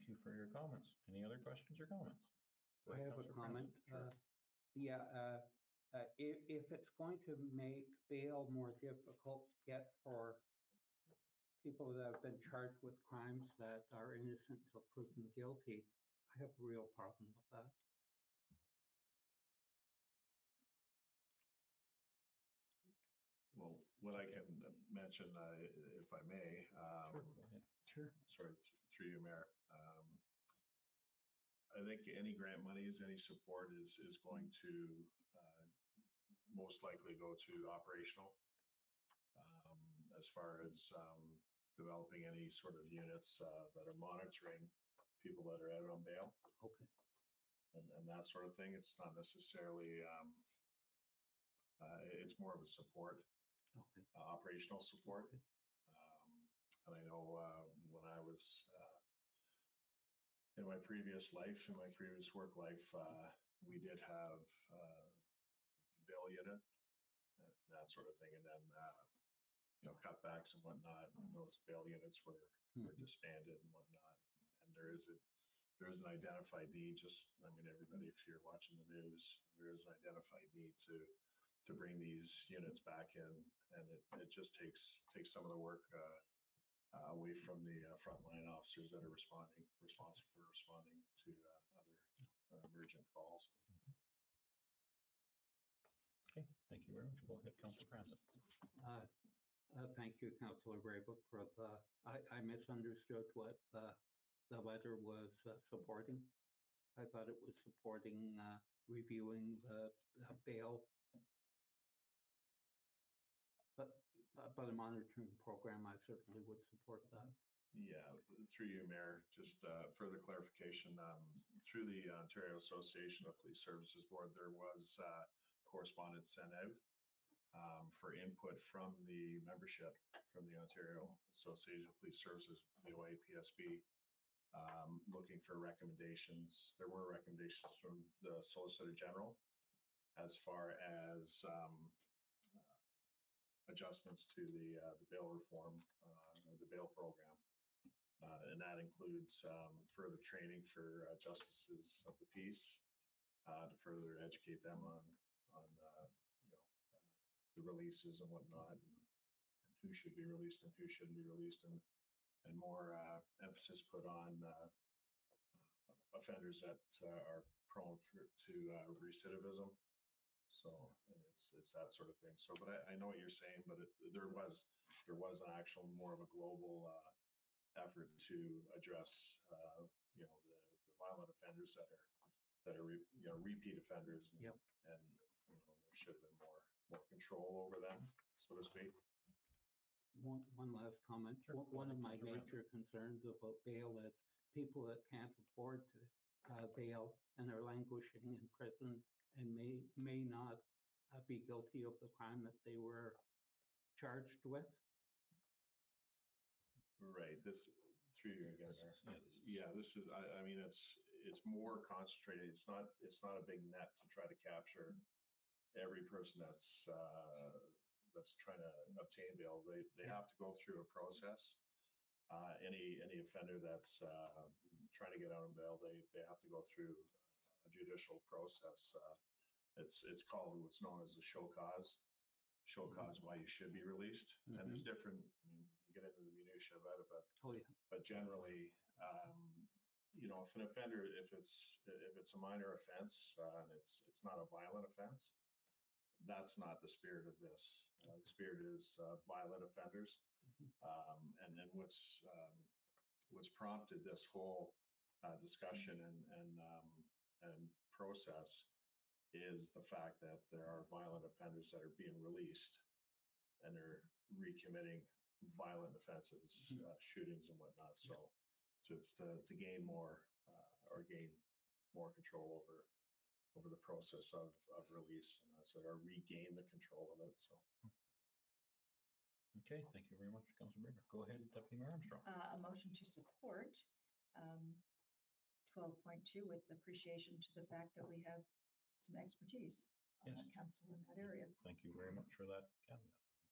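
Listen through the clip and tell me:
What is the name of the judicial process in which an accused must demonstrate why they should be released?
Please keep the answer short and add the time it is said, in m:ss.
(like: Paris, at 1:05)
show cause, at 3:51.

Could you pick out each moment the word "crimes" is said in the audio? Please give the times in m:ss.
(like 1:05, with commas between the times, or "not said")
0:13, 3:22.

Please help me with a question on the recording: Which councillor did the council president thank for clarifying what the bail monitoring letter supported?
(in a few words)
Councillor Braybrook.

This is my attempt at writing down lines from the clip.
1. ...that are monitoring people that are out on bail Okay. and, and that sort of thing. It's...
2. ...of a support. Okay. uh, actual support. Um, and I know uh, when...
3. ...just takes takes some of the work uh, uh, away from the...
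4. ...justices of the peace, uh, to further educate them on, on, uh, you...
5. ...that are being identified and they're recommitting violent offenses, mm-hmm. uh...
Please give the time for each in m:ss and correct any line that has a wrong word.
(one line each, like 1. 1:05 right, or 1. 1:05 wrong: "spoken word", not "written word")
1. 0:43 right
2. 0:52 wrong: "operational", not "actual"
3. 1:24 right
4. 2:31 right
5. 4:21 wrong: "released", not "identified".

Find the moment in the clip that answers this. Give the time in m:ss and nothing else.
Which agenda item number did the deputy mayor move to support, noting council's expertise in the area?
4:45.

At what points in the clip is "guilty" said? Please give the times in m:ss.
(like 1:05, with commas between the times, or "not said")
0:15, 3:21.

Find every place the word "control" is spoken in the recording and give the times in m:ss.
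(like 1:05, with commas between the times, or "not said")
3:07, 4:32, 4:36.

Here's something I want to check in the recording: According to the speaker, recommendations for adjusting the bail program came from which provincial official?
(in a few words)
Solicitor General.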